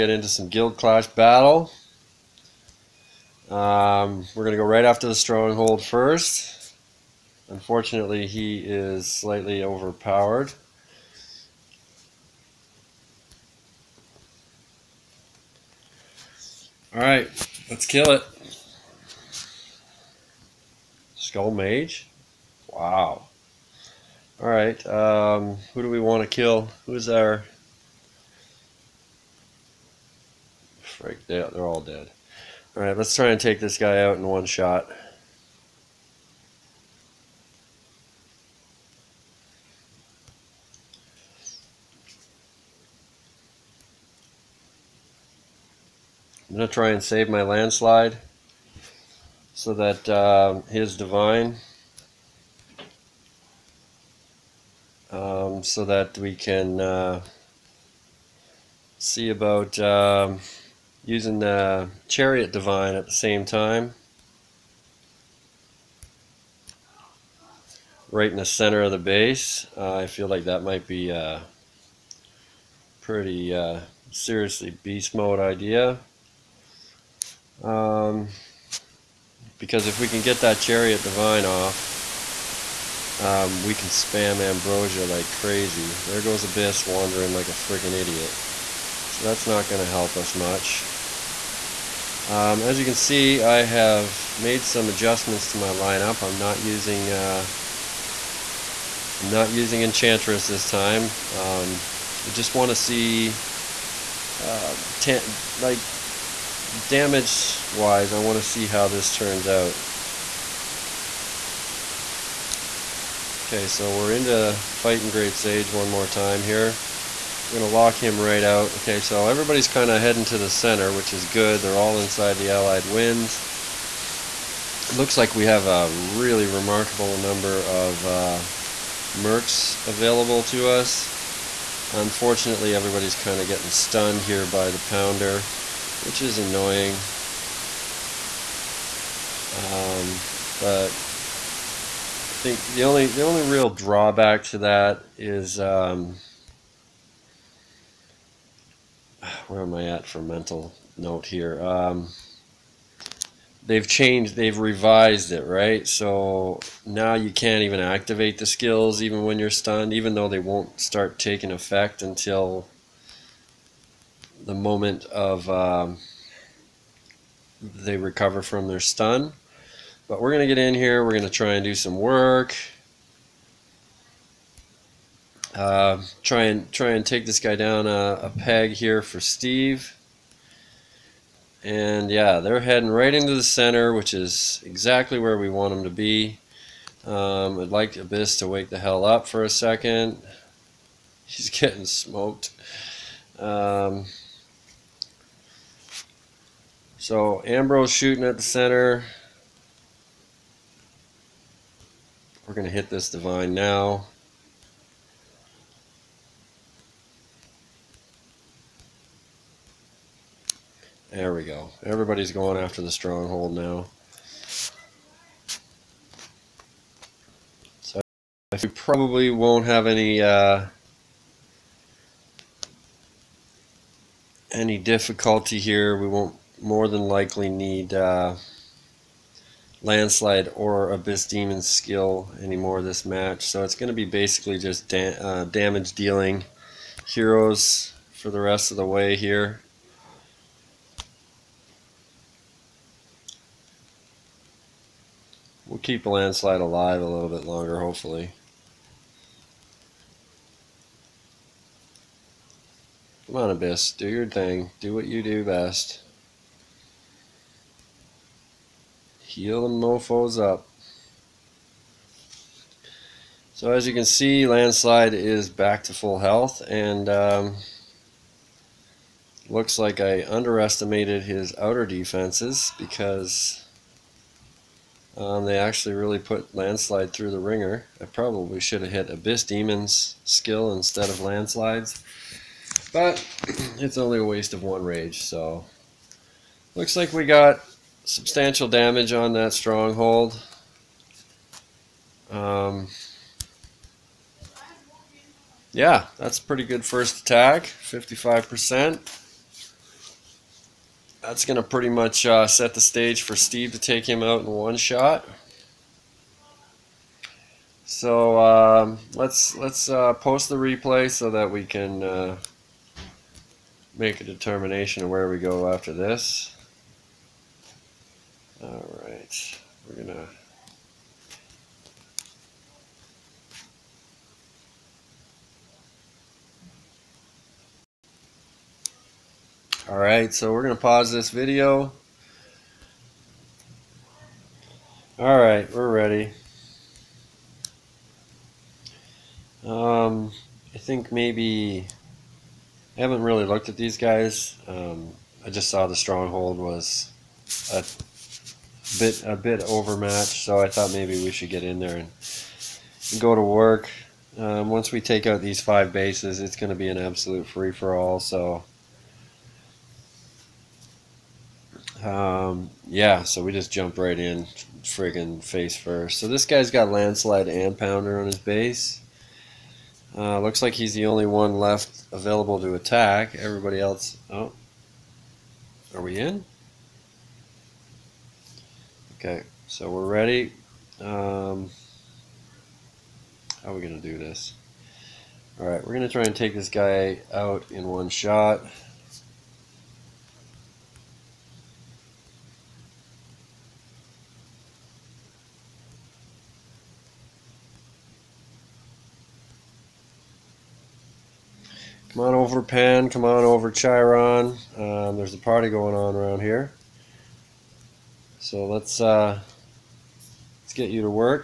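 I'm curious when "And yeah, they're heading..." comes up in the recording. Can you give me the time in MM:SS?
03:01.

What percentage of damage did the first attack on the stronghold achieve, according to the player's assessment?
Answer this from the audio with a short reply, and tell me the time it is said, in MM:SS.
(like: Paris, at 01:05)
55%, at 04:57.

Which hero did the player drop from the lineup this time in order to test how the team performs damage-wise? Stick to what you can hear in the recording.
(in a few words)
Enchantress.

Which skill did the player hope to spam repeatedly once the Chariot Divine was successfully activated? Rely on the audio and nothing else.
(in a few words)
Ambrosia.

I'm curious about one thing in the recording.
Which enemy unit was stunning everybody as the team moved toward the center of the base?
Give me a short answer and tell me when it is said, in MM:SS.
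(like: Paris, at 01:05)
the pounder, at 02:14.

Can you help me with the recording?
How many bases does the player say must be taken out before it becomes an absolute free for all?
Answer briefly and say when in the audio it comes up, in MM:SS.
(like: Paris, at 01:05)
5, at 05:55.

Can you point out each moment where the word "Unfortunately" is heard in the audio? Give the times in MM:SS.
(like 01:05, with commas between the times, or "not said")
00:07, 02:11.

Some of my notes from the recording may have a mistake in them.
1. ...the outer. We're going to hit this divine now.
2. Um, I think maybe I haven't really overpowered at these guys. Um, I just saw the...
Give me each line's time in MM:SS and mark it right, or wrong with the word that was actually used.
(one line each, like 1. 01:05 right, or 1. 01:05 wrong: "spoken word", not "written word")
1. 03:18 wrong: "center", not "outer"
2. 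05:39 wrong: "looked", not "overpowered".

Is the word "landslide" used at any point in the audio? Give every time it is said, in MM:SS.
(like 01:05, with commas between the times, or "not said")
00:47, 03:49, 04:06, 04:24, 04:36, 04:41, 06:06.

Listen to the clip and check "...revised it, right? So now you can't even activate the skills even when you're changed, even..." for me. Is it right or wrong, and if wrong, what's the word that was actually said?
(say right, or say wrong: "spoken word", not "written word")
wrong: "stunned", not "changed".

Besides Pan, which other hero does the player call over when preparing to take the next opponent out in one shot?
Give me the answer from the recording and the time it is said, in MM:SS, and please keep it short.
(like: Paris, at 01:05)
Chiron, at 06:43.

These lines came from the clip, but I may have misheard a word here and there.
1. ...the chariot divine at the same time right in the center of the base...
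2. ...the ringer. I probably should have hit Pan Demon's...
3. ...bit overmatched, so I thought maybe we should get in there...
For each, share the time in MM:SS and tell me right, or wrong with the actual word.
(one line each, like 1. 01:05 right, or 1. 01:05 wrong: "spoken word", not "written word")
1. 01:01 right
2. 04:37 wrong: "Abyss", not "Pan"
3. 05:49 right.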